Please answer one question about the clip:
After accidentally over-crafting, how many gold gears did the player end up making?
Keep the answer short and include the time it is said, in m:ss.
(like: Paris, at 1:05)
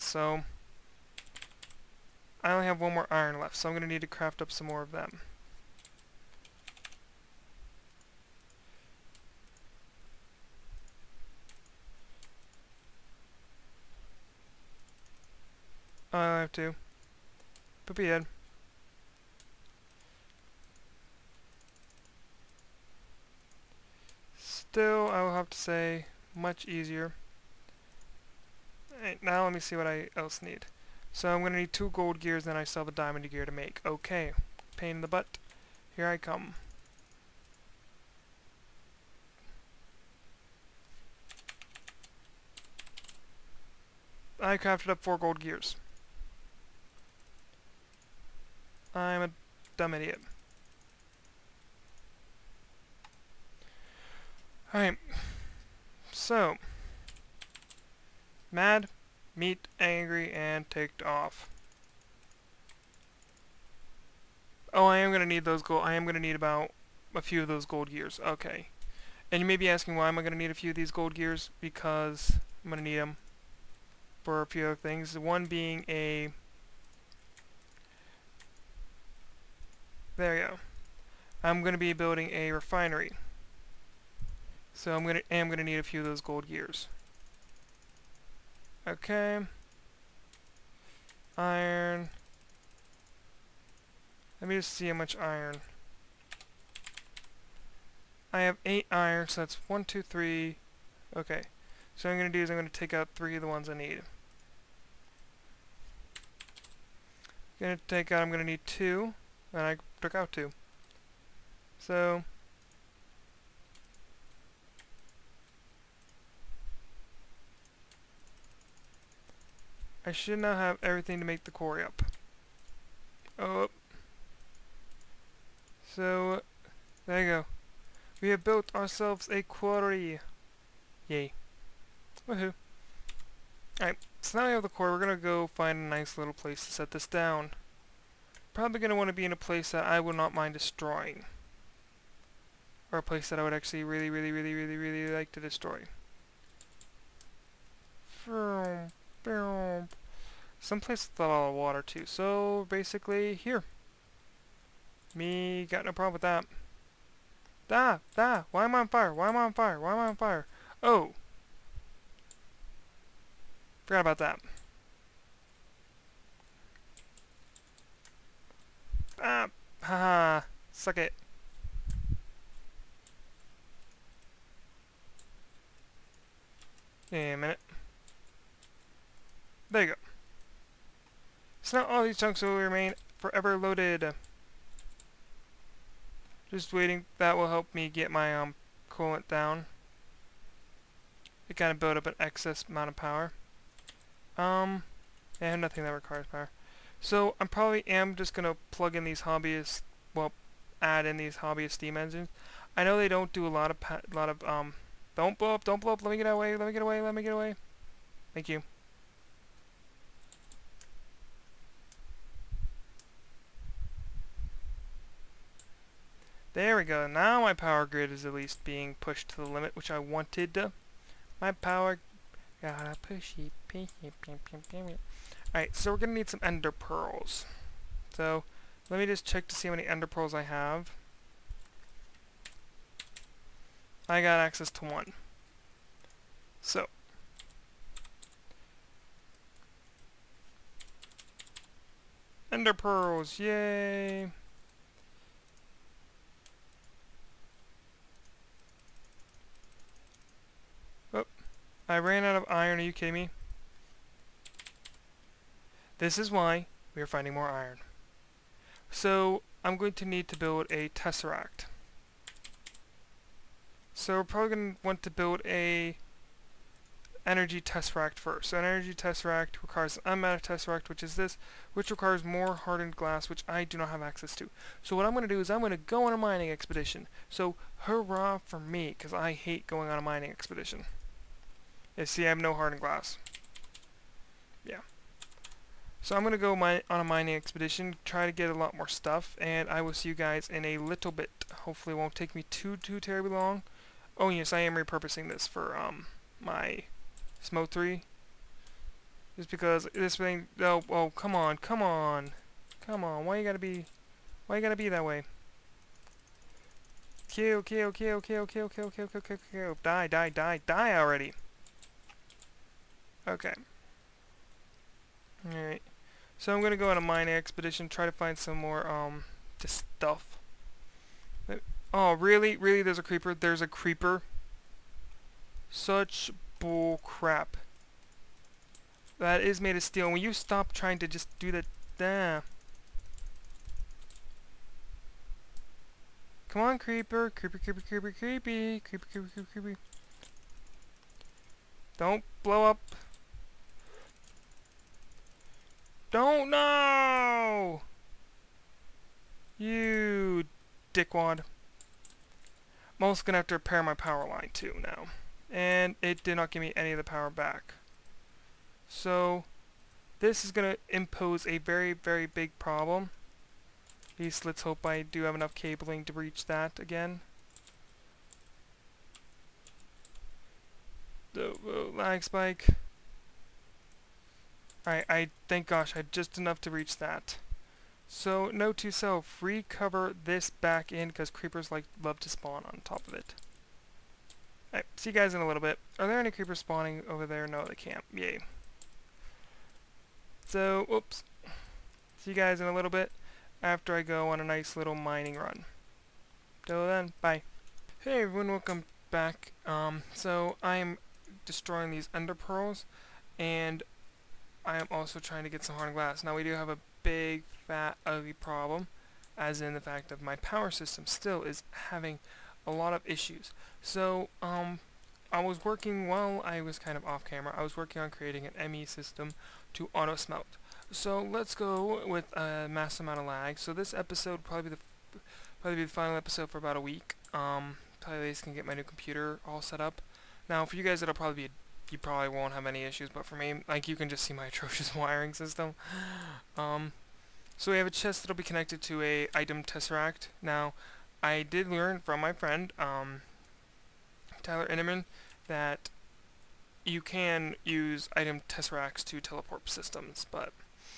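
4, at 0:45.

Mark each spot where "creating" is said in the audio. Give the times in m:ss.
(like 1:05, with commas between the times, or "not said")
6:58.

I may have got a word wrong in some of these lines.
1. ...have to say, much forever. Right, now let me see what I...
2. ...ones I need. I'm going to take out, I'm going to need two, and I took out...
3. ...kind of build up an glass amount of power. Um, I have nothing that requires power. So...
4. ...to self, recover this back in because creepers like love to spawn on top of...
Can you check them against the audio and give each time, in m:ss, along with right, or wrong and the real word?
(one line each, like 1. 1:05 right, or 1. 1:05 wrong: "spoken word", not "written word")
1. 0:25 wrong: "easier", not "forever"
2. 1:43 right
3. 3:11 wrong: "excess", not "glass"
4. 6:18 right.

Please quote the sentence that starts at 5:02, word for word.
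Come on, why you gotta be...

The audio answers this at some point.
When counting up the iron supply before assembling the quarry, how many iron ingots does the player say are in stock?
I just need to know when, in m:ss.
1:38.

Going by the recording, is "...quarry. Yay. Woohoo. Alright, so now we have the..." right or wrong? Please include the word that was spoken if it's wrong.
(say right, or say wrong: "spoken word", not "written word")
right.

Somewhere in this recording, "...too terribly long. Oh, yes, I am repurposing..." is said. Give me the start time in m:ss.
4:52.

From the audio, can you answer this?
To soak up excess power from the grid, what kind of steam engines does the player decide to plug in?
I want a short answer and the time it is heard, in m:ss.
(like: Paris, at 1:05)
Hobbyist steam engines, at 3:21.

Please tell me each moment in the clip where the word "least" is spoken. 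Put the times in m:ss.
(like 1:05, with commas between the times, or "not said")
3:38, 6:04, 7:08.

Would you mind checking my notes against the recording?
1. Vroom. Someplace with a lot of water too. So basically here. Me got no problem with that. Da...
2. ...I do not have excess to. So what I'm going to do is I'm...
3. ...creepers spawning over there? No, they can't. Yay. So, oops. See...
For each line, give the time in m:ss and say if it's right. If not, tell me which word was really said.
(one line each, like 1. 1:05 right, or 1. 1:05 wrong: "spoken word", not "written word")
1. 2:28 right
2. 4:33 wrong: "access", not "excess"
3. 6:26 right.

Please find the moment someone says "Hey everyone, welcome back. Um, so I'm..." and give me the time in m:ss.
6:38.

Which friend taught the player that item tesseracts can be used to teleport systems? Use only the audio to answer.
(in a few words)
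Tyler Inneman.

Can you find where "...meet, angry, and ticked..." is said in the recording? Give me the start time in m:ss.
0:59.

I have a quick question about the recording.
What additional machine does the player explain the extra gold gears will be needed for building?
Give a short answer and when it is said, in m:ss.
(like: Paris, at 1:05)
Refinery, at 1:22.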